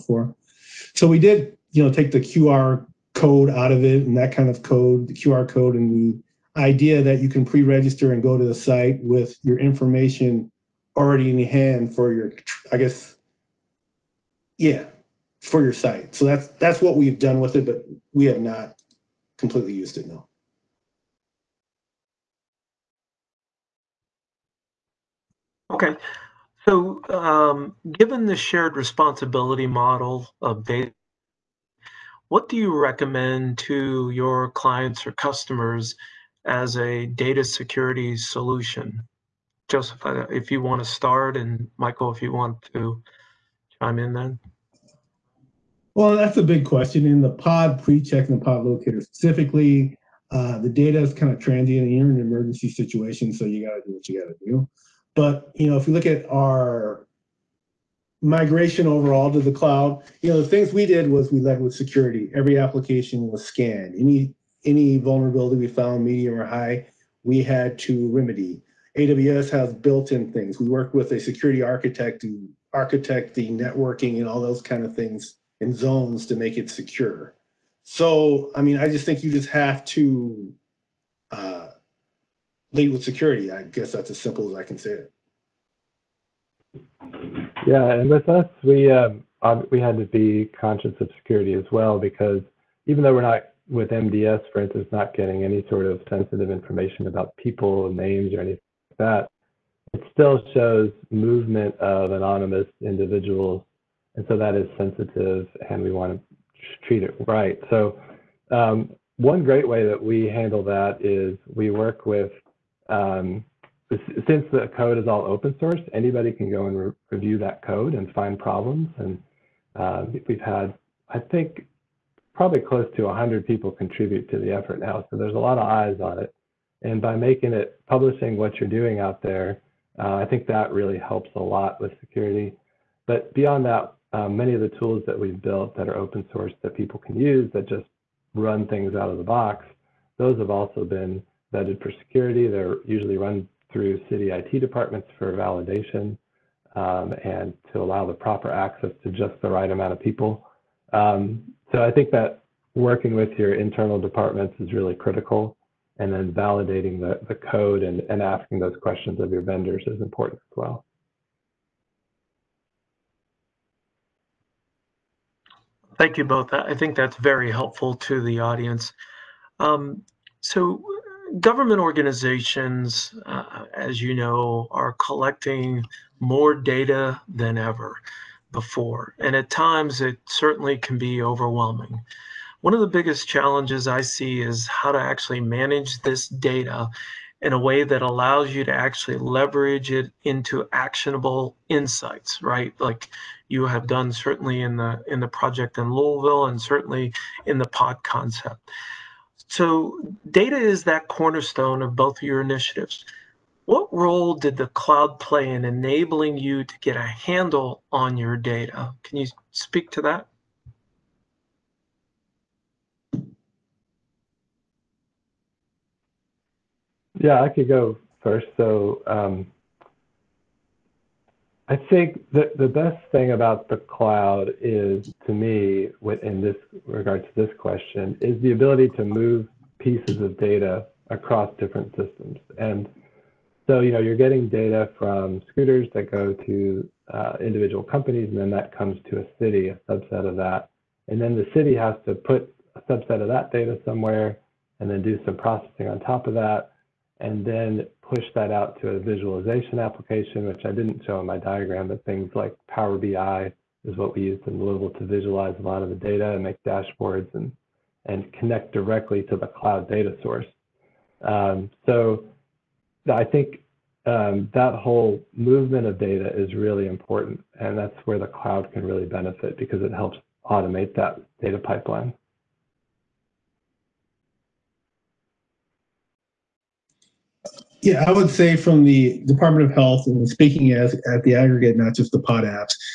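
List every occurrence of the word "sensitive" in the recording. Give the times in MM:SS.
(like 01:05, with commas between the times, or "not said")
01:36, 01:44.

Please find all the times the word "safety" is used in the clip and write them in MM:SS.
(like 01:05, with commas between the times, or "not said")
not said.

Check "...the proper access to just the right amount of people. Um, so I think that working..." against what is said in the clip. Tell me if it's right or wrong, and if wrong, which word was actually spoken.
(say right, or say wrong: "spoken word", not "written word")
right.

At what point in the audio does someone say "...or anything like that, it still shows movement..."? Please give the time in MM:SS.
01:38.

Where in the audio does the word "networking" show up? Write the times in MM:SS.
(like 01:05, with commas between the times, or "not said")
01:13.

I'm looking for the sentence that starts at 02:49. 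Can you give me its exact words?
Um, so, government organizations, uh, as you know, are collecting more data than ever before.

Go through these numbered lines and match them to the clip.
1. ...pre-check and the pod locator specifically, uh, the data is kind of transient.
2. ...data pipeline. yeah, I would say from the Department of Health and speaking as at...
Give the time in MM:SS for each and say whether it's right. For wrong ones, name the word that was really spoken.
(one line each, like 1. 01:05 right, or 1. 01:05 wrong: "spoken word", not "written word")
1. 00:47 right
2. 04:31 right.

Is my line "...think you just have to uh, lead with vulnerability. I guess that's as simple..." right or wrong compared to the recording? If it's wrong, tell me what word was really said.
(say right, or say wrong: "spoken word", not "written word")
wrong: "security", not "vulnerability".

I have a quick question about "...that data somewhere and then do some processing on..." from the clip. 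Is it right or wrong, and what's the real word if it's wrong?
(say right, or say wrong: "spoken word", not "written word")
right.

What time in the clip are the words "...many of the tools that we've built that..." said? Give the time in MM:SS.
02:14.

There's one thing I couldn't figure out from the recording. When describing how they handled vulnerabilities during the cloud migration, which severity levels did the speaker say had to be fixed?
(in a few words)
medium or high.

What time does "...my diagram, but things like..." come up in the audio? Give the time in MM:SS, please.
04:11.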